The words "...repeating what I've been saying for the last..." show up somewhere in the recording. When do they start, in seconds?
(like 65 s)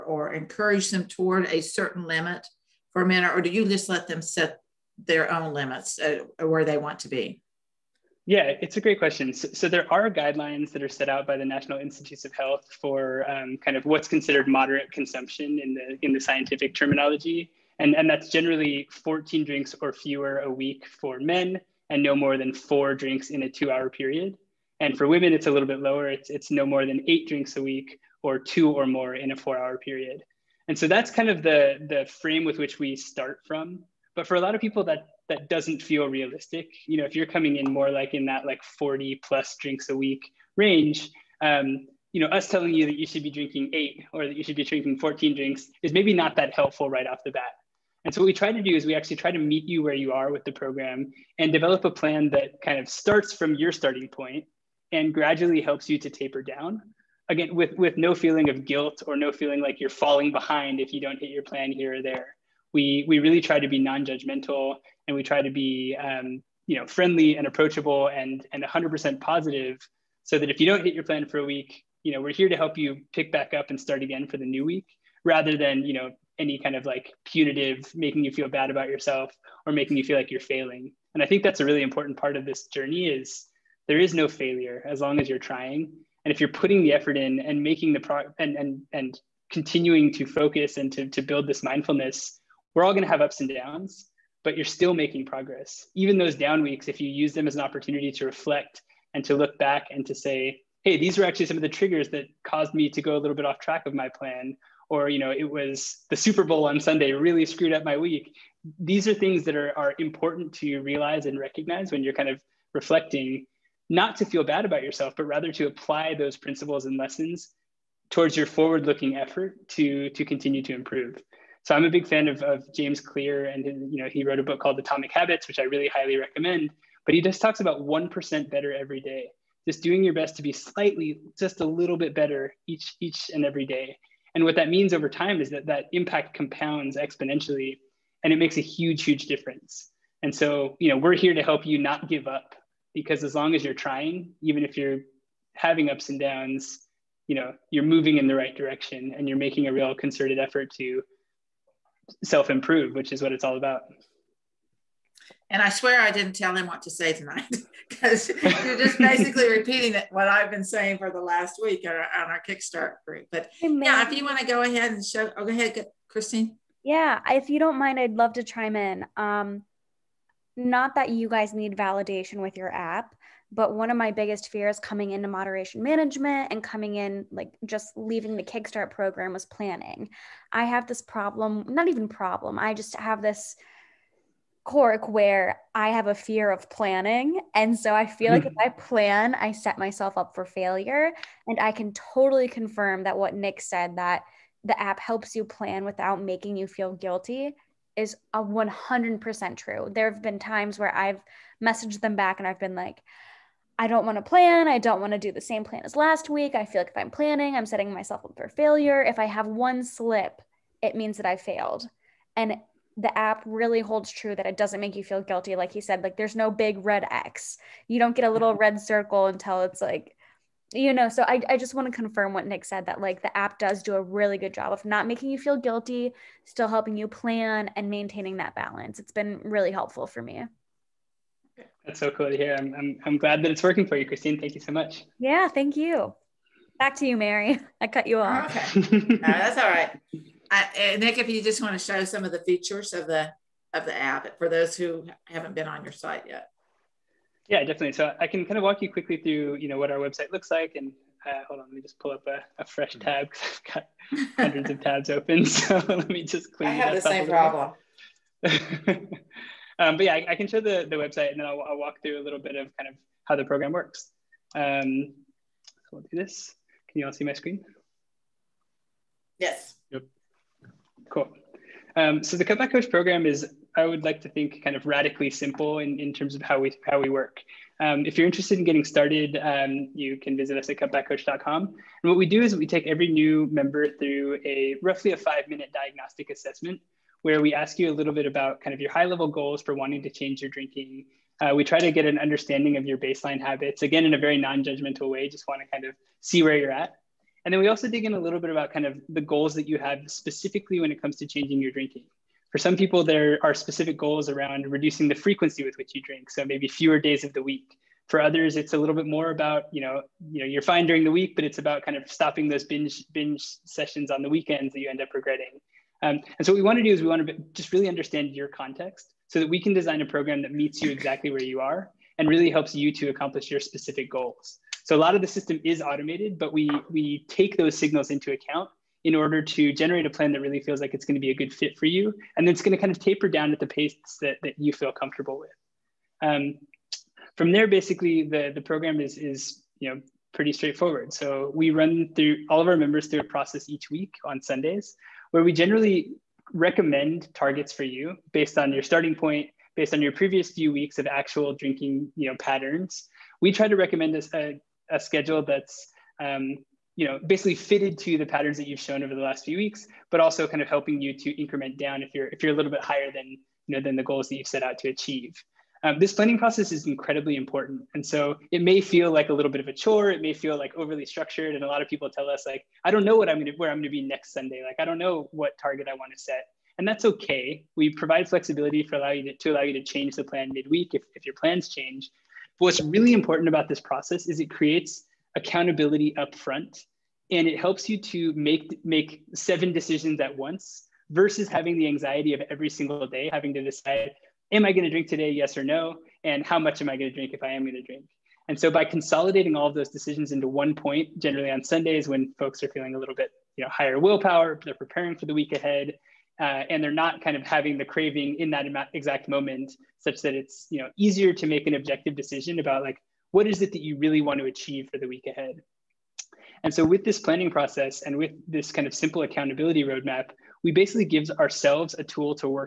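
159 s.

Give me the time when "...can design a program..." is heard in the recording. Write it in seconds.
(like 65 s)
319 s.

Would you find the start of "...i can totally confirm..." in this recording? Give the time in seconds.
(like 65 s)
191 s.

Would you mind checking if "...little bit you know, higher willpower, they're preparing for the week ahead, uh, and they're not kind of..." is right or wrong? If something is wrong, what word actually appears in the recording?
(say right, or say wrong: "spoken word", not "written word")
right.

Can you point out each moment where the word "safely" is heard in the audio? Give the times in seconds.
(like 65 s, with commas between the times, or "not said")
not said.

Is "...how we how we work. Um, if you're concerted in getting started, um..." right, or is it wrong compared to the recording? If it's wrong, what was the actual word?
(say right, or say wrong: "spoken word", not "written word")
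wrong: "interested", not "concerted".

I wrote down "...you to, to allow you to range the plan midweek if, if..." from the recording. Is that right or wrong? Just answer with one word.
wrong.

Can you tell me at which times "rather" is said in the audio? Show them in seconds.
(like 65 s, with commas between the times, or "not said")
75 s, 115 s.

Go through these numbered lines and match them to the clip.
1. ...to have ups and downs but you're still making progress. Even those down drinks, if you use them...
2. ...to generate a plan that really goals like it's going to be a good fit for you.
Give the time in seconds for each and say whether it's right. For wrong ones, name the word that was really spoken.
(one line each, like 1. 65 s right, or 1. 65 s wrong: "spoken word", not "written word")
1. 93 s wrong: "weeks", not "drinks"
2. 329 s wrong: "feels", not "goals".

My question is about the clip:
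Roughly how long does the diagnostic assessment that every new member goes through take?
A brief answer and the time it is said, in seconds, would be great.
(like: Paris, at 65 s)
5 minutes, at 285 s.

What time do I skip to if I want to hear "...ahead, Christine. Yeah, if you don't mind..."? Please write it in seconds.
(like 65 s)
165 s.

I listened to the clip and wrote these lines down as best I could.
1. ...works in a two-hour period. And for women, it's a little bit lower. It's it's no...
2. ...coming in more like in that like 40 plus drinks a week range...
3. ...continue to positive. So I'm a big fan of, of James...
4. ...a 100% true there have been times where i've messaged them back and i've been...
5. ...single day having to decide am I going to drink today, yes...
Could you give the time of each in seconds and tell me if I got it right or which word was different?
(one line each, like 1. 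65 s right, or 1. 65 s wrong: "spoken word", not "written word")
1. 22 s wrong: "drinks", not "works"
2. 37 s right
3. 120 s wrong: "improve", not "positive"
4. 198 s right
5. 392 s right.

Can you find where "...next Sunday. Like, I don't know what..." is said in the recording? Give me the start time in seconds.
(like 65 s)
374 s.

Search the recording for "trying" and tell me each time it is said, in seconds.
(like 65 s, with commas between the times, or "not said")
85 s, 143 s.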